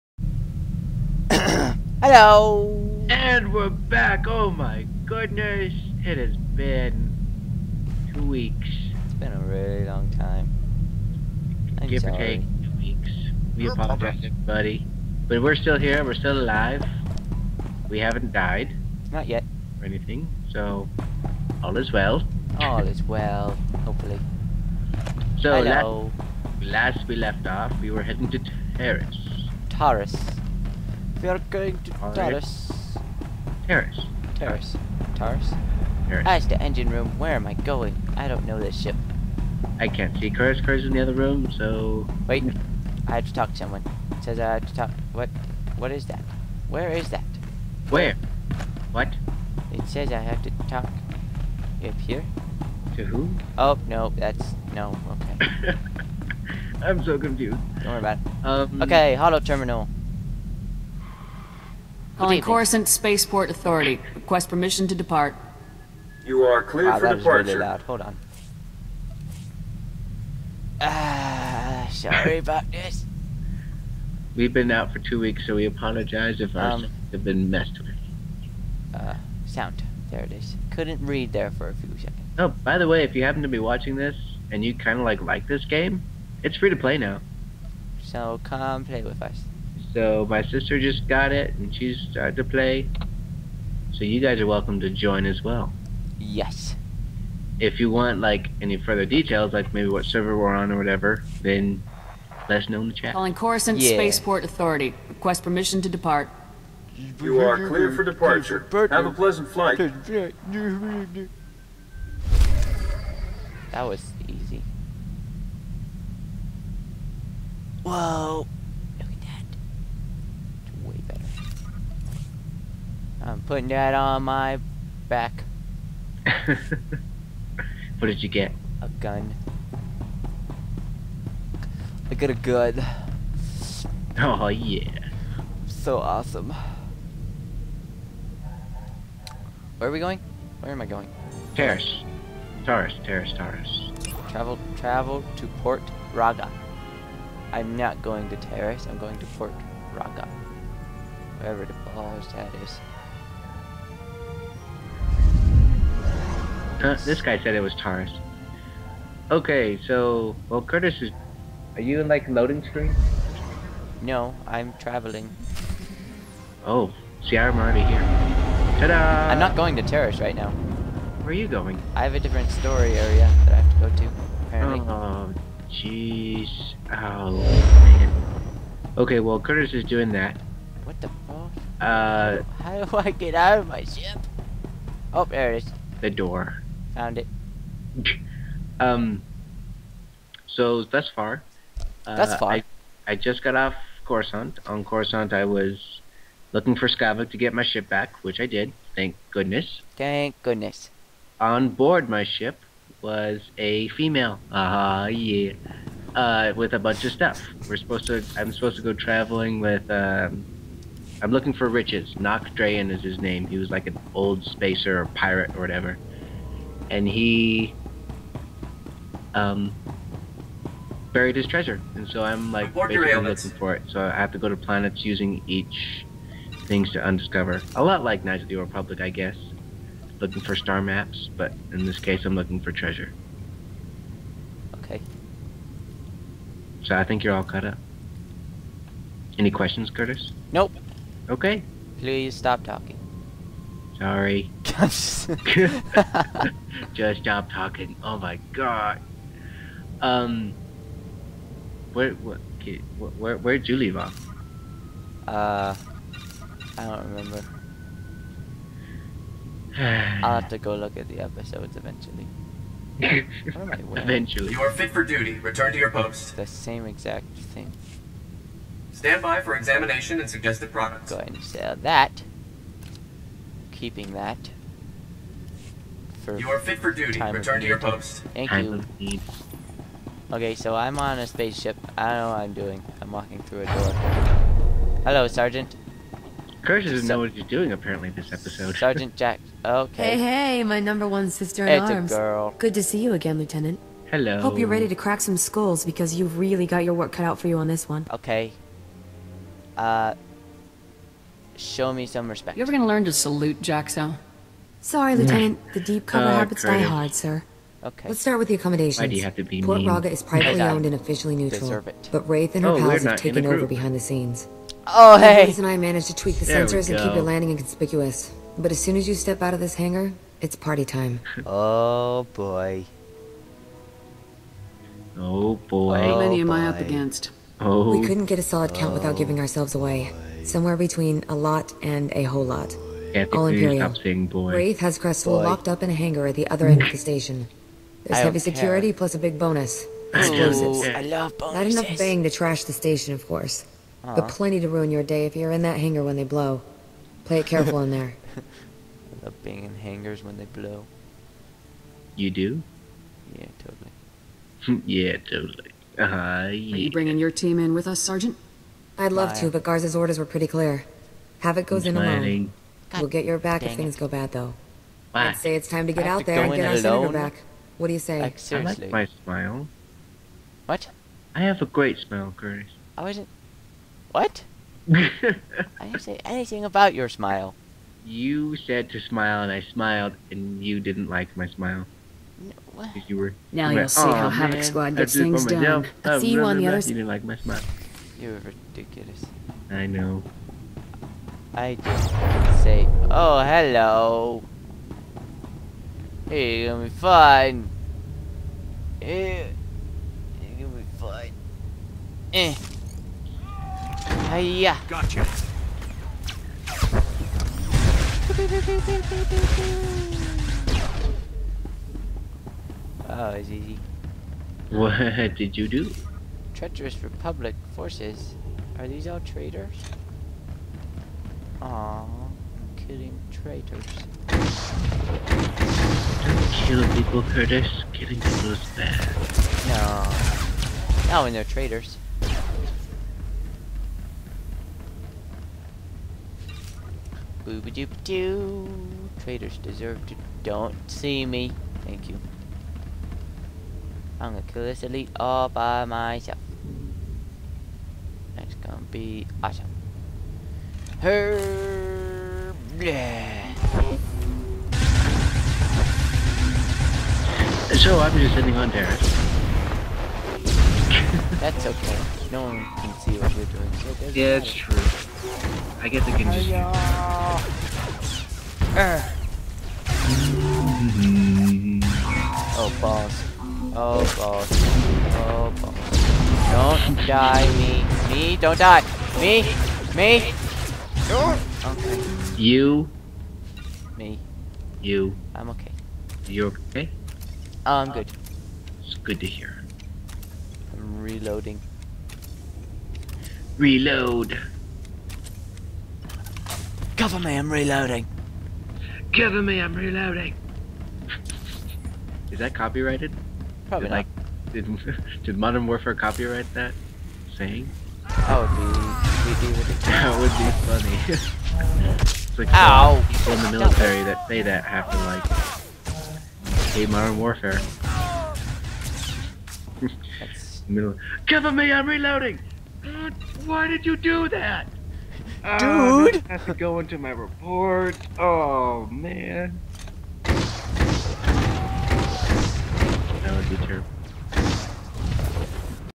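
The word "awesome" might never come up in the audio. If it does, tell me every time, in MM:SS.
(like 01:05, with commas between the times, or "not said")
02:15, 07:29.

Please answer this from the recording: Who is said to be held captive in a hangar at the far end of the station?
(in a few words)
Crestfall.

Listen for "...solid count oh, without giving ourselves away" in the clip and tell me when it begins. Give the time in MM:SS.
05:28.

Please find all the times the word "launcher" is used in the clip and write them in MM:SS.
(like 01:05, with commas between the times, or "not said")
not said.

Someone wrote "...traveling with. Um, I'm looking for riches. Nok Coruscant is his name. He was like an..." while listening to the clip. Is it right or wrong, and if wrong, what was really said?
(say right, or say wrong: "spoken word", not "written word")
wrong: "Drayen", not "Coruscant".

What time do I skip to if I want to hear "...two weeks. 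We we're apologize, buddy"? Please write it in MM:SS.
00:12.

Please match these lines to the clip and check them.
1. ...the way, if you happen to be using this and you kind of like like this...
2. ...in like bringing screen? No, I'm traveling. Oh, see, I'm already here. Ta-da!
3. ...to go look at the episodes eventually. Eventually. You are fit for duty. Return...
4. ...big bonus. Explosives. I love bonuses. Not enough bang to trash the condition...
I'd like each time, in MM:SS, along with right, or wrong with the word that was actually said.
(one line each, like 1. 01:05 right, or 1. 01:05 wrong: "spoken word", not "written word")
1. 01:22 wrong: "watching", not "using"
2. 02:42 wrong: "loading", not "bringing"
3. 04:20 right
4. 05:39 wrong: "station", not "condition".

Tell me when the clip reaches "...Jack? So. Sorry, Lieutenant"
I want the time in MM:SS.
05:03.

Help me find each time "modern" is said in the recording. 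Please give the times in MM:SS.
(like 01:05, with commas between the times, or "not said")
08:25, 08:36.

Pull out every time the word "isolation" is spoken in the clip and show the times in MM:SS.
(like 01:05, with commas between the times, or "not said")
not said.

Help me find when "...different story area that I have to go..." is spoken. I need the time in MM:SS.
02:52.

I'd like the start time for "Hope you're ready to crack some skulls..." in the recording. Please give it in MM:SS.
04:54.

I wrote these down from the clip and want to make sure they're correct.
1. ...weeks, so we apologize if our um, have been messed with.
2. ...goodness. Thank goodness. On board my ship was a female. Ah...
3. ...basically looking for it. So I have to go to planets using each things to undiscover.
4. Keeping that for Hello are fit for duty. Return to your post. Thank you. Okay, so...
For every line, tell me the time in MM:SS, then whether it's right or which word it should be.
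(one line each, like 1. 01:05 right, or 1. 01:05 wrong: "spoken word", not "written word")
1. 01:15 right
2. 03:19 right
3. 03:42 right
4. 04:33 wrong: "You", not "Hello".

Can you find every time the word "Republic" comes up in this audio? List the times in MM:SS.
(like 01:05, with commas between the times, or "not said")
03:48, 06:57.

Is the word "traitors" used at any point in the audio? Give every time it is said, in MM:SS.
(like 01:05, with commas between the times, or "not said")
06:59, 07:03, 07:11, 07:19.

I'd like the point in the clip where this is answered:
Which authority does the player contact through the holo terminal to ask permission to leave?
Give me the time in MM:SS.
01:02.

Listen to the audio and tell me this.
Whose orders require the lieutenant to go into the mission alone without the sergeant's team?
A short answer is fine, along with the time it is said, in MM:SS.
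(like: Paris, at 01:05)
Garza, at 05:59.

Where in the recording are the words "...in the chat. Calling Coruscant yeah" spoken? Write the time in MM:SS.
01:42.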